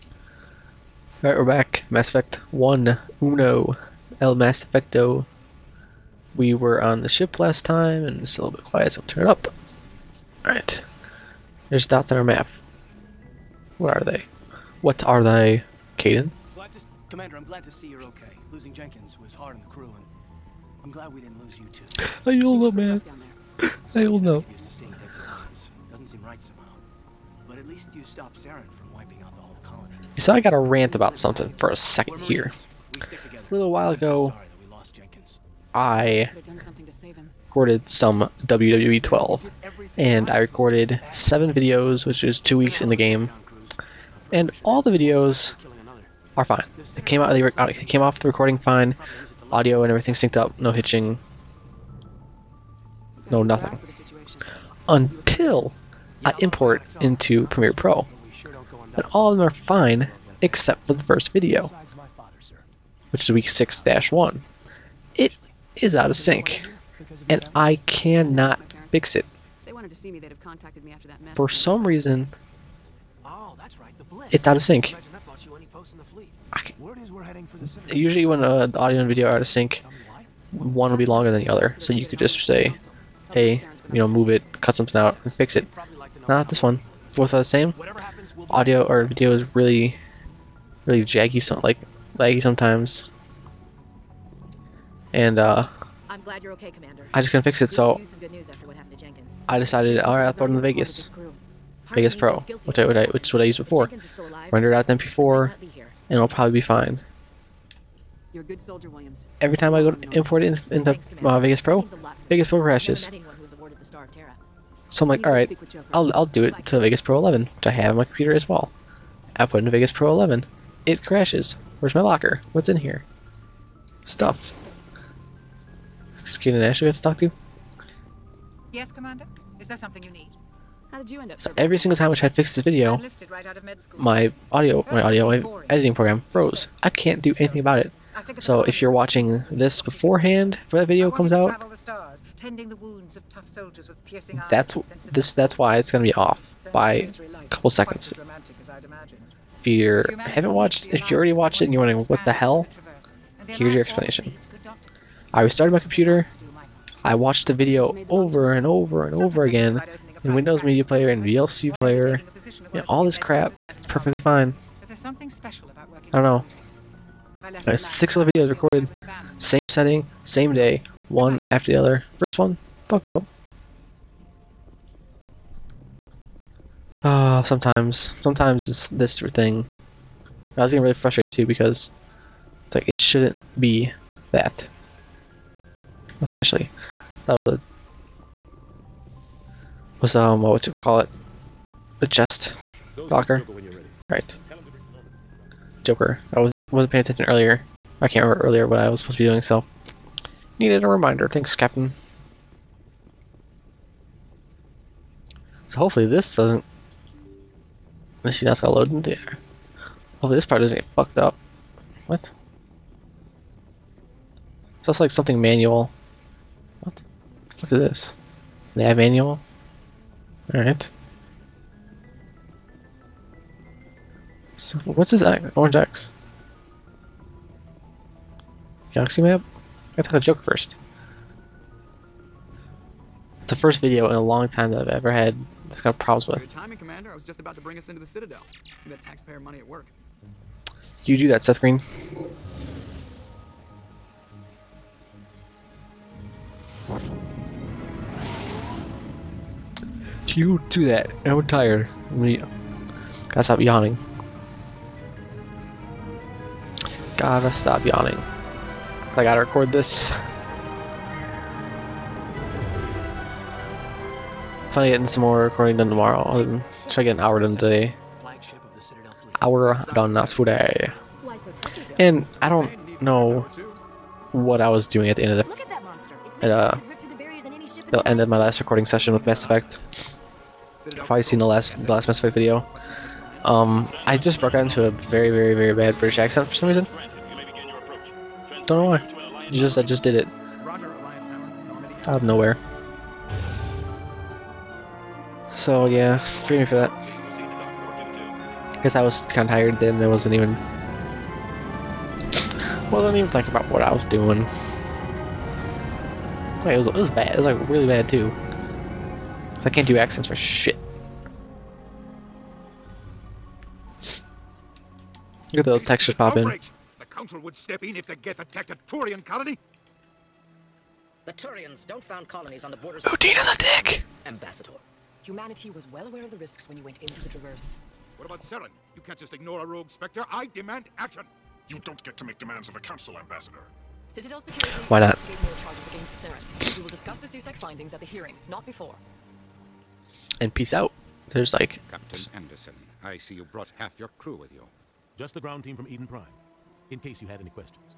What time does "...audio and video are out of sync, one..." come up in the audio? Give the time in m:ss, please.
1:18.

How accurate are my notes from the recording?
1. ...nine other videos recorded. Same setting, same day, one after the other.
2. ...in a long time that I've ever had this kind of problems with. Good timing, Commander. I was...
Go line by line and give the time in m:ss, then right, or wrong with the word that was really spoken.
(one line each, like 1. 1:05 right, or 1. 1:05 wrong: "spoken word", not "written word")
1. 2:47 wrong: "six", not "nine"
2. 3:54 right.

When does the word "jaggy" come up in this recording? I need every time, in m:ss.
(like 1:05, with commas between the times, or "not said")
1:31.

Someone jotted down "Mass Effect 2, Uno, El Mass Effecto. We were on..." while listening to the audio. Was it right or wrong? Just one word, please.
wrong.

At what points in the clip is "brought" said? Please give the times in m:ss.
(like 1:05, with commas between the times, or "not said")
5:43.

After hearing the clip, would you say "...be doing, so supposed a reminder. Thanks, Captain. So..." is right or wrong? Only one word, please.
wrong.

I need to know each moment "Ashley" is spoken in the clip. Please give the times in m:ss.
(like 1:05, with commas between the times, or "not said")
2:06, 3:06.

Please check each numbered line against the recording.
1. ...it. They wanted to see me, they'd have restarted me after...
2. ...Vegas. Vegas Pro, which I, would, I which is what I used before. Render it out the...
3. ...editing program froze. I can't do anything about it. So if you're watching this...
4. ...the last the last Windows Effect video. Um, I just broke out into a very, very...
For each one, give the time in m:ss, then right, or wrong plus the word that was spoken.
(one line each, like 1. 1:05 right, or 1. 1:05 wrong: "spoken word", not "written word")
1. 1:09 wrong: "contacted", not "restarted"
2. 1:40 right
3. 2:15 right
4. 4:41 wrong: "Mass", not "Windows".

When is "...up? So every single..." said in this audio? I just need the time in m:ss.
2:11.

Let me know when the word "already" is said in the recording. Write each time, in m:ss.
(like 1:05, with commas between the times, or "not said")
2:31.